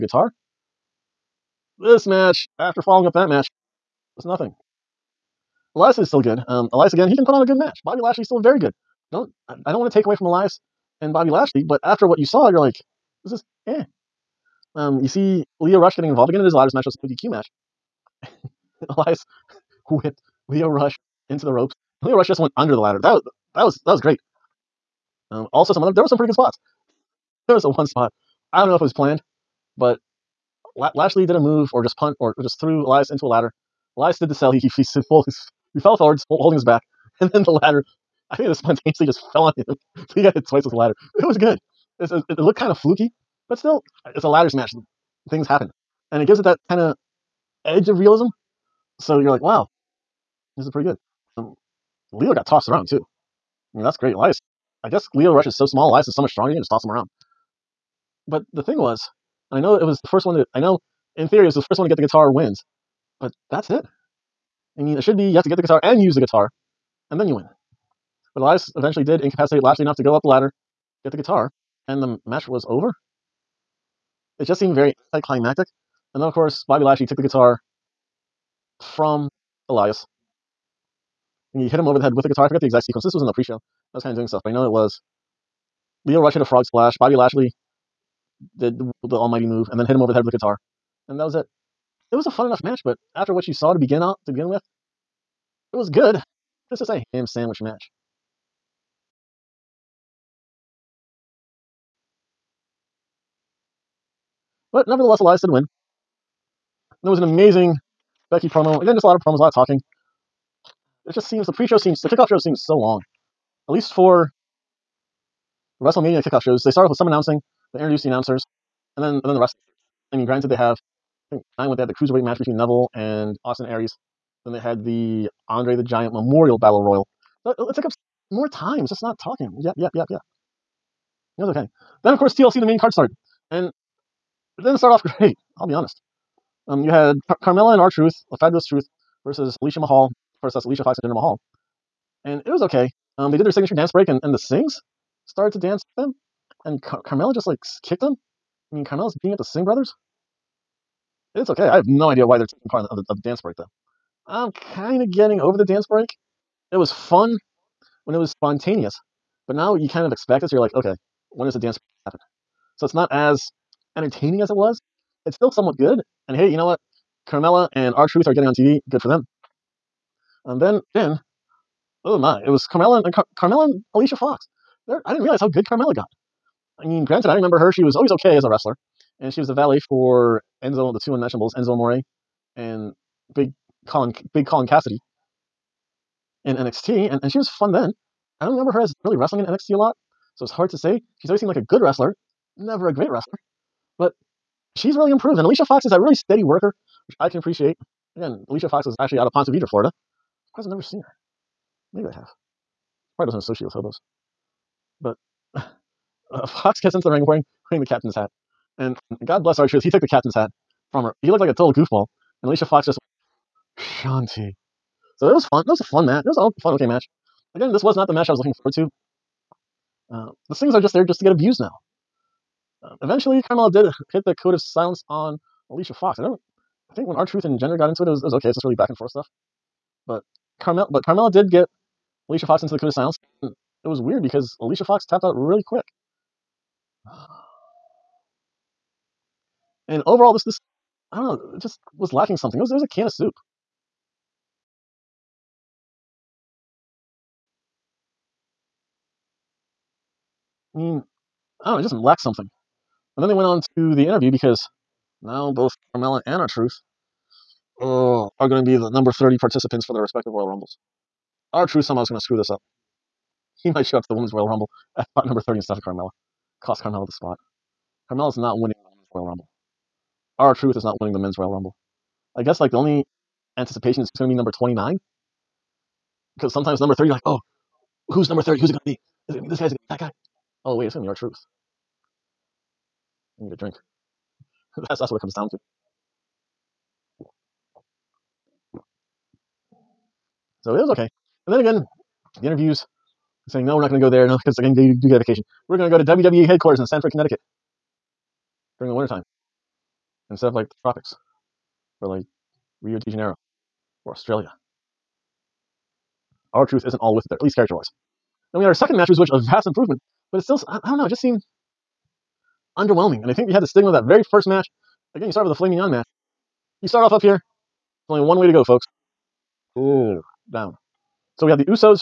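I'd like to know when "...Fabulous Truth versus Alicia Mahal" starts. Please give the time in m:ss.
2:18.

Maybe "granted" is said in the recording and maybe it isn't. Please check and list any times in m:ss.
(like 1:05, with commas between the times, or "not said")
2:00, 2:57.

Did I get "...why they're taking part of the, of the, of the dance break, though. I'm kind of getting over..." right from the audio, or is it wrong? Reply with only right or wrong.
right.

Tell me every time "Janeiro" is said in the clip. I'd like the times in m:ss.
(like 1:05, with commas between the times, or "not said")
5:03.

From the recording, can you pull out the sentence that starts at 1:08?
But Elias eventually did incapacitate Lashley enough to go up the ladder, get the guitar, and the match was over.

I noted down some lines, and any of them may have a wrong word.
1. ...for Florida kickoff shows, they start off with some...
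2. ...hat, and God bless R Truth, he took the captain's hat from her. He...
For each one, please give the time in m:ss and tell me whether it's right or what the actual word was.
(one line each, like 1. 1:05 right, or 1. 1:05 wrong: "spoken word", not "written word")
1. 1:53 wrong: "WrestleMania", not "Florida"
2. 3:28 right.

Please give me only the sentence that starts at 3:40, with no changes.
Uh, the things are just there just to get abused now eventually, Carmella did hit the code of silence on Alicia Fox.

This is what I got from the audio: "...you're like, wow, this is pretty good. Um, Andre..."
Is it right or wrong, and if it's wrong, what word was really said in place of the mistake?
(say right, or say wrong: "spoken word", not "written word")
wrong: "Lio", not "Andre".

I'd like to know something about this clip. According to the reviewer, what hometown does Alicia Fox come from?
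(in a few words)
Ponte Vedra, Florida.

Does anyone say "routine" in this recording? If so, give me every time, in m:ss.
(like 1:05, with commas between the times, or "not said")
not said.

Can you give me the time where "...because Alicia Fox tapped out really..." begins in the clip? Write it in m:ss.
3:54.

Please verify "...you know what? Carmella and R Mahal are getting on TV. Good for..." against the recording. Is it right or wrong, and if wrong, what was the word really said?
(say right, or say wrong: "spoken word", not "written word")
wrong: "Truth", not "Mahal".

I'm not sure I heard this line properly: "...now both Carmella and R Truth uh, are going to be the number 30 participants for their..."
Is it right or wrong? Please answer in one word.
right.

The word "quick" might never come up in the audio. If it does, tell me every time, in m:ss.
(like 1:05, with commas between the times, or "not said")
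3:55.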